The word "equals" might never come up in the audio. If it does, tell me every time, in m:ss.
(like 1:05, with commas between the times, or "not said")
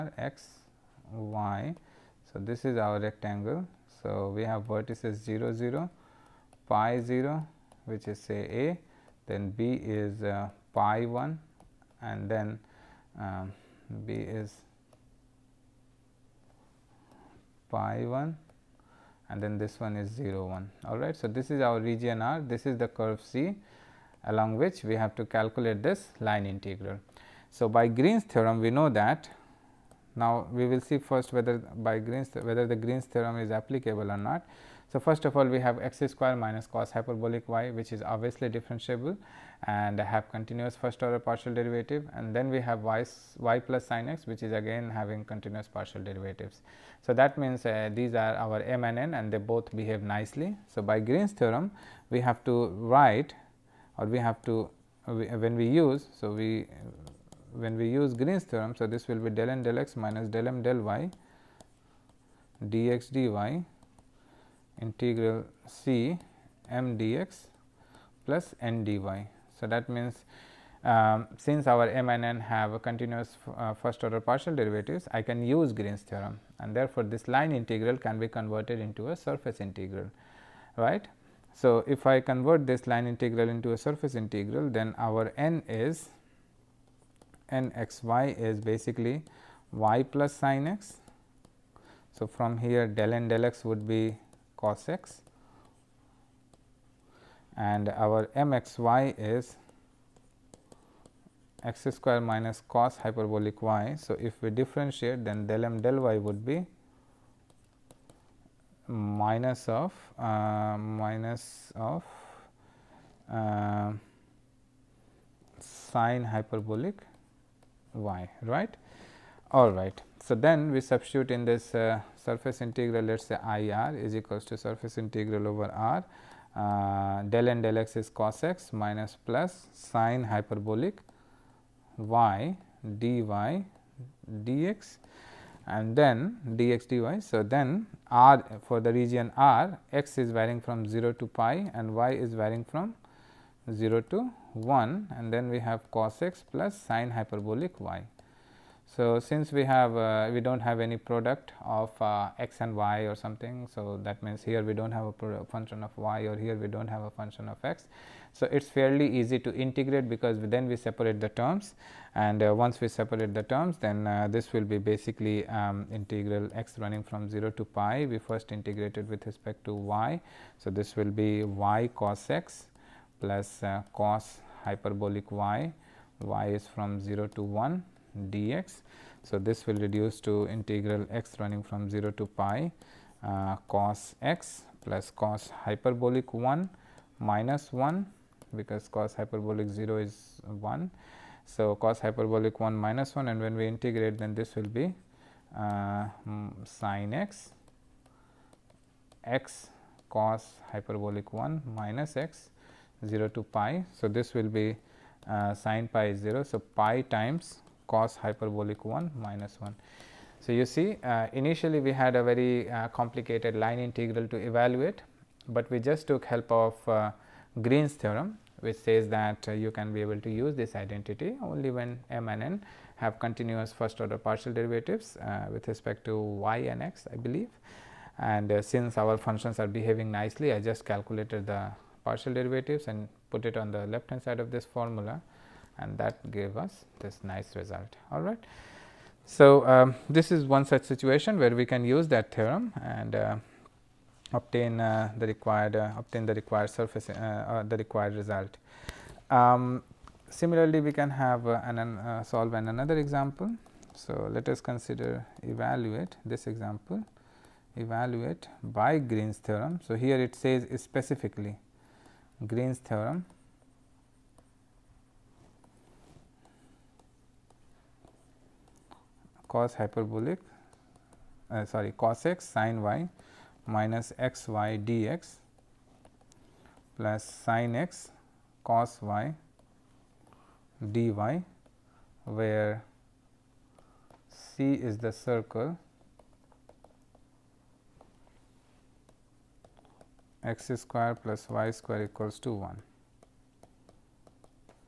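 2:04, 4:52.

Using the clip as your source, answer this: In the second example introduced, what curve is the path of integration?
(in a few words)
circle x^2 + y^2 = 1.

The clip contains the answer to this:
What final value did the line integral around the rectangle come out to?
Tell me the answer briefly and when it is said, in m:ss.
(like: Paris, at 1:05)
pi times (cosh 1 minus 1), at 3:26.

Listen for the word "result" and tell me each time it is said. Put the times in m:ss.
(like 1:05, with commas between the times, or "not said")
3:57, 4:08.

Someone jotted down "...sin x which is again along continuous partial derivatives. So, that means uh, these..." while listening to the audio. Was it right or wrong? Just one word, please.
wrong.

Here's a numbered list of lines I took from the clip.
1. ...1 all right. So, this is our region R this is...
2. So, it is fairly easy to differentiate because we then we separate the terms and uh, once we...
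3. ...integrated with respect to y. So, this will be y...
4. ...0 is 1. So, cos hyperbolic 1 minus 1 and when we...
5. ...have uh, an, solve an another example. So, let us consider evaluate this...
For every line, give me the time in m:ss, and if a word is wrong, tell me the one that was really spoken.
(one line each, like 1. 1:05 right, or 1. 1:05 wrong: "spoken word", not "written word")
1. 0:20 right
2. 2:38 wrong: "integrate", not "differentiate"
3. 2:48 right
4. 3:09 right
5. 4:11 right.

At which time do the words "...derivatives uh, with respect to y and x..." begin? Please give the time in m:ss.
3:44.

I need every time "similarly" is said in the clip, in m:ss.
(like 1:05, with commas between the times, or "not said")
4:10.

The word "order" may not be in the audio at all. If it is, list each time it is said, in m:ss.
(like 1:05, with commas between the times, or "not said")
0:41, 1:14, 3:44.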